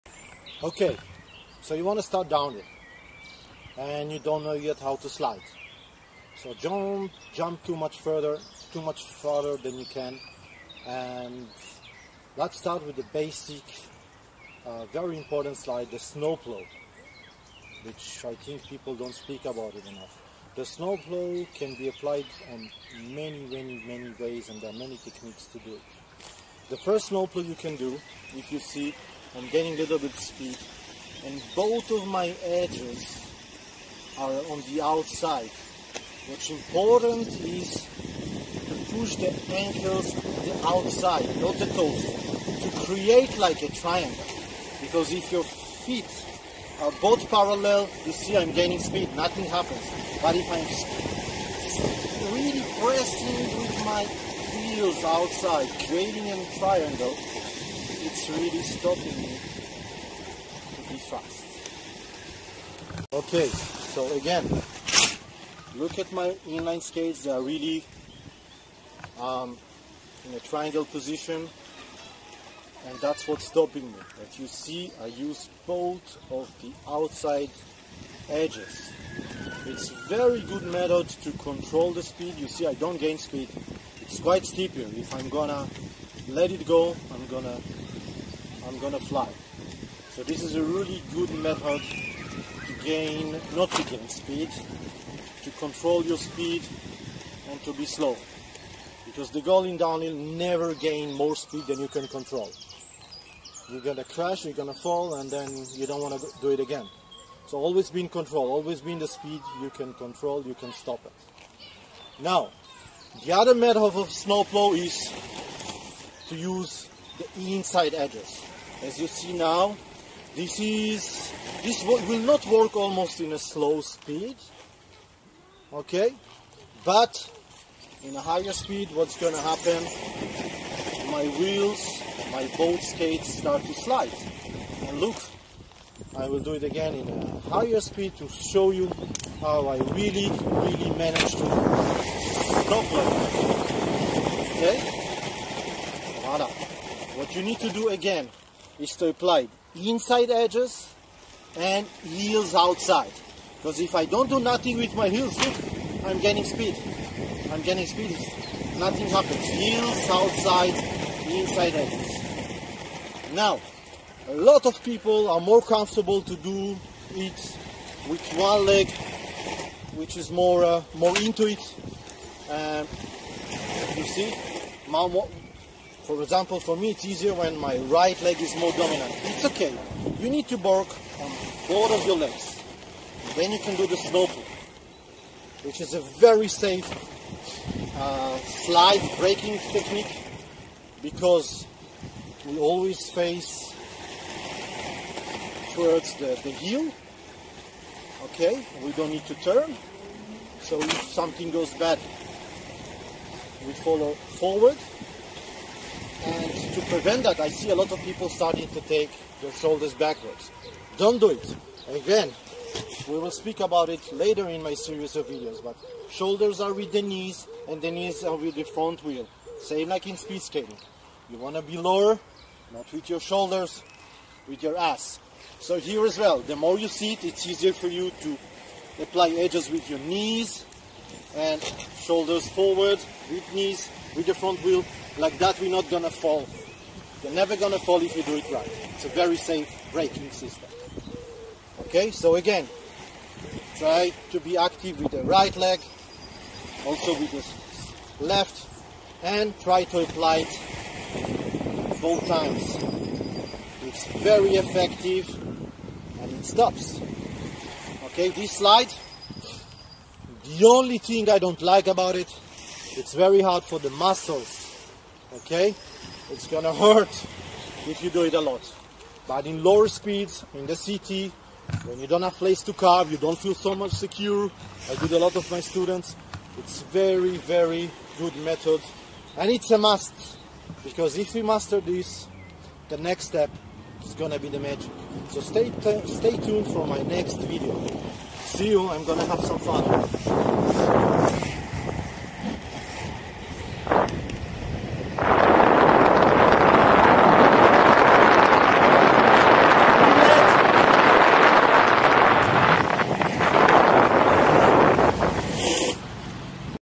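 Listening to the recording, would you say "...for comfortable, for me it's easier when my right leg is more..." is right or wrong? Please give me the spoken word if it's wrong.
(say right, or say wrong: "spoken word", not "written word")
wrong: "example", not "comfortable".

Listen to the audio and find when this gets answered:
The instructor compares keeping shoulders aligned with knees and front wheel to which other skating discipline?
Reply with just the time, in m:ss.
3:40.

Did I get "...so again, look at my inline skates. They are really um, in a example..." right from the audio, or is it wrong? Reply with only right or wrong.
wrong.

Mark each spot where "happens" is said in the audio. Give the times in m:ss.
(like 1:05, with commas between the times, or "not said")
0:49, 2:09, 2:39.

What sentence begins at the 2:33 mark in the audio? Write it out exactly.
Because if I don't do nothing with my heels, look, I'm gaining speed.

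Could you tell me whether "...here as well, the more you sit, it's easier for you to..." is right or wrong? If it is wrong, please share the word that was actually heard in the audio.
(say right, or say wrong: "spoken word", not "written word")
right.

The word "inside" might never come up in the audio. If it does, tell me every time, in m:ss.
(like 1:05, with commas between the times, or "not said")
1:57, 2:29, 2:41.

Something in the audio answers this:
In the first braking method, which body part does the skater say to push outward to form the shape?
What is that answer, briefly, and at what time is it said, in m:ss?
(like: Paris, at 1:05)
Ankles, at 0:39.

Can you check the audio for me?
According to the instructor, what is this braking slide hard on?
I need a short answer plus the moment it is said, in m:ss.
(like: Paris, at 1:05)
The muscles, at 4:23.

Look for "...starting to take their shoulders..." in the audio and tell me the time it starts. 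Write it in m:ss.
3:28.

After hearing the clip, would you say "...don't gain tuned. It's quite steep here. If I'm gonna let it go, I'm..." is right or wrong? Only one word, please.
wrong.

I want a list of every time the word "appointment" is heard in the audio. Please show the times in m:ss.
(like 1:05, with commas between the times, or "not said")
not said.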